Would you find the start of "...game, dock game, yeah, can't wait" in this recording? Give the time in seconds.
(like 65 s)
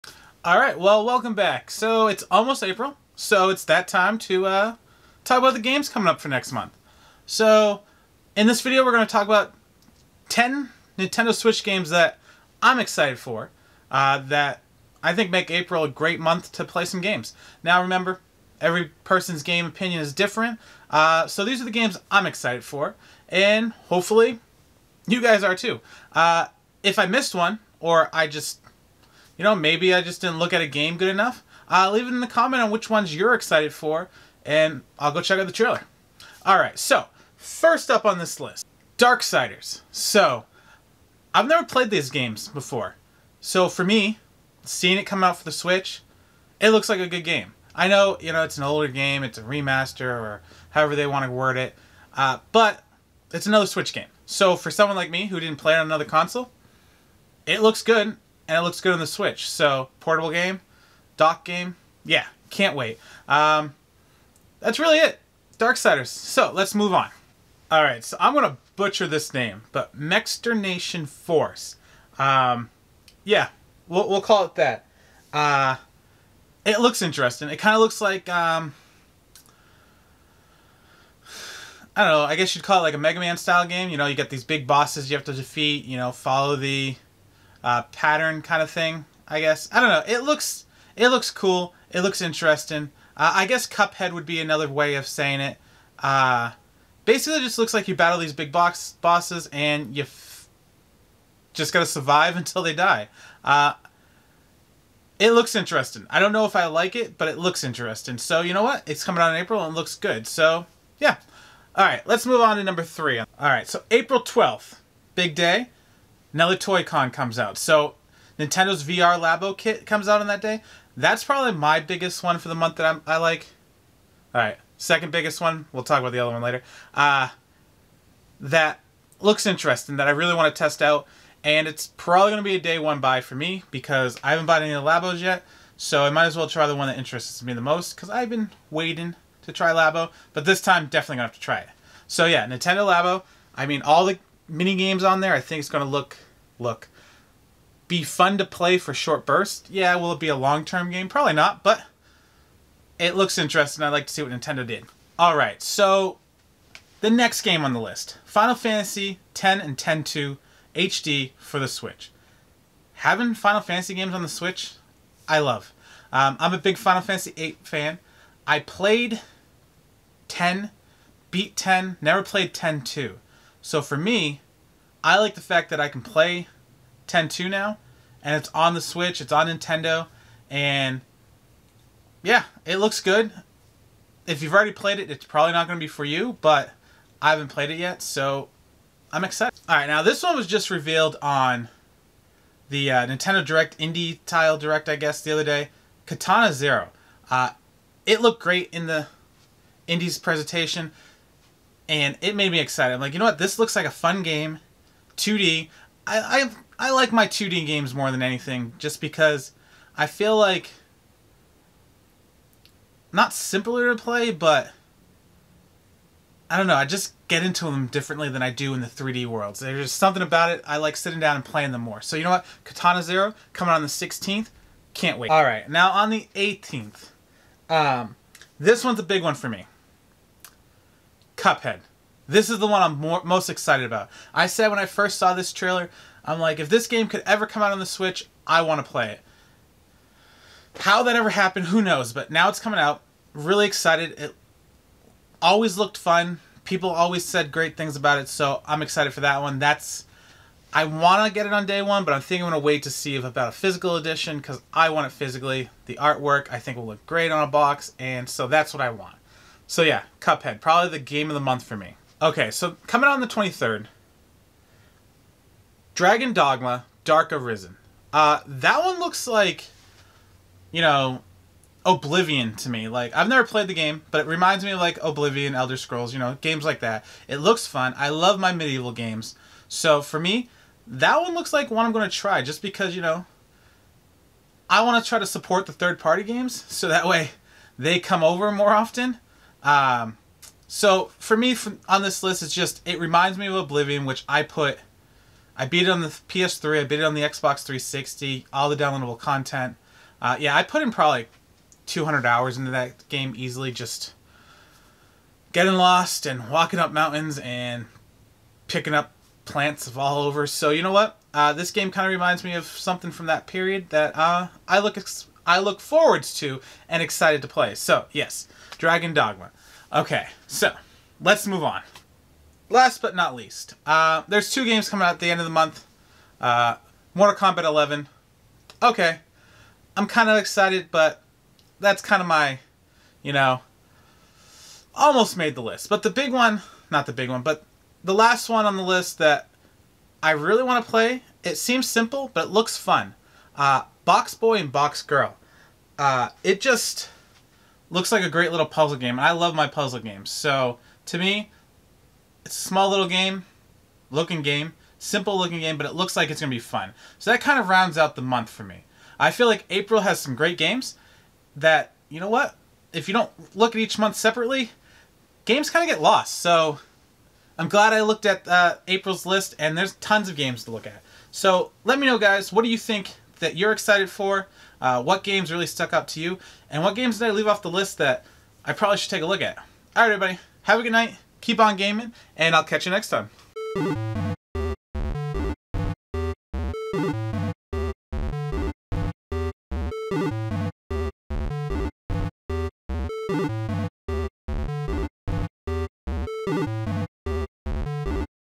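60 s.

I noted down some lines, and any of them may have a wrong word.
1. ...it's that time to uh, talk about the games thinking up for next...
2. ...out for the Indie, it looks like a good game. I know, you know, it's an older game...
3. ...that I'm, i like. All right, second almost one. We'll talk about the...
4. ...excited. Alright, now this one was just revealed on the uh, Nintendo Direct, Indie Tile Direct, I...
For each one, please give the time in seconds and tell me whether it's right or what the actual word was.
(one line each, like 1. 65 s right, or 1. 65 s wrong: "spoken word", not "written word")
1. 3 s wrong: "coming", not "thinking"
2. 45 s wrong: "Switch", not "Indie"
3. 122 s wrong: "biggest", not "almost"
4. 189 s right.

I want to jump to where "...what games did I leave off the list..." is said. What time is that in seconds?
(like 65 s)
376 s.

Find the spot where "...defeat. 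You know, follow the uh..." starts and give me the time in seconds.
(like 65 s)
85 s.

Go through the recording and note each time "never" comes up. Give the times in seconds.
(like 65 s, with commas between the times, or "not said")
41 s, 171 s, 273 s.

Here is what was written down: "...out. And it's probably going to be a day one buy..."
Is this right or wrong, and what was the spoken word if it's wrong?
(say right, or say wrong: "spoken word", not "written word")
right.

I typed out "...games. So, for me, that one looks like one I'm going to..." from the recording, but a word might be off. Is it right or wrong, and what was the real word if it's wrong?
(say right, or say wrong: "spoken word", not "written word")
right.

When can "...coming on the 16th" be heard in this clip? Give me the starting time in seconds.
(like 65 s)
223 s.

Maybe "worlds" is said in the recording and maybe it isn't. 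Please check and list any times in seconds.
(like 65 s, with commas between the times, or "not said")
219 s.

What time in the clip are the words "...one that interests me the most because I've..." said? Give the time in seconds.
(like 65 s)
136 s.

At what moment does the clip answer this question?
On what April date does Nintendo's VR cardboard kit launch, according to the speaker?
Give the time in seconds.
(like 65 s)
113 s.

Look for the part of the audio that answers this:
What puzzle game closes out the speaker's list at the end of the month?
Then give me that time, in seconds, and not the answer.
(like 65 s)
344 s.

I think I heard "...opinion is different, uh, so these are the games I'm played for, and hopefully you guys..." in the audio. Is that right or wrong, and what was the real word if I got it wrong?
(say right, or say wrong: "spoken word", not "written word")
wrong: "excited", not "played".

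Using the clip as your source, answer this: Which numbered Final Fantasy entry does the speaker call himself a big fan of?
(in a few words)
Final Fantasy VIII.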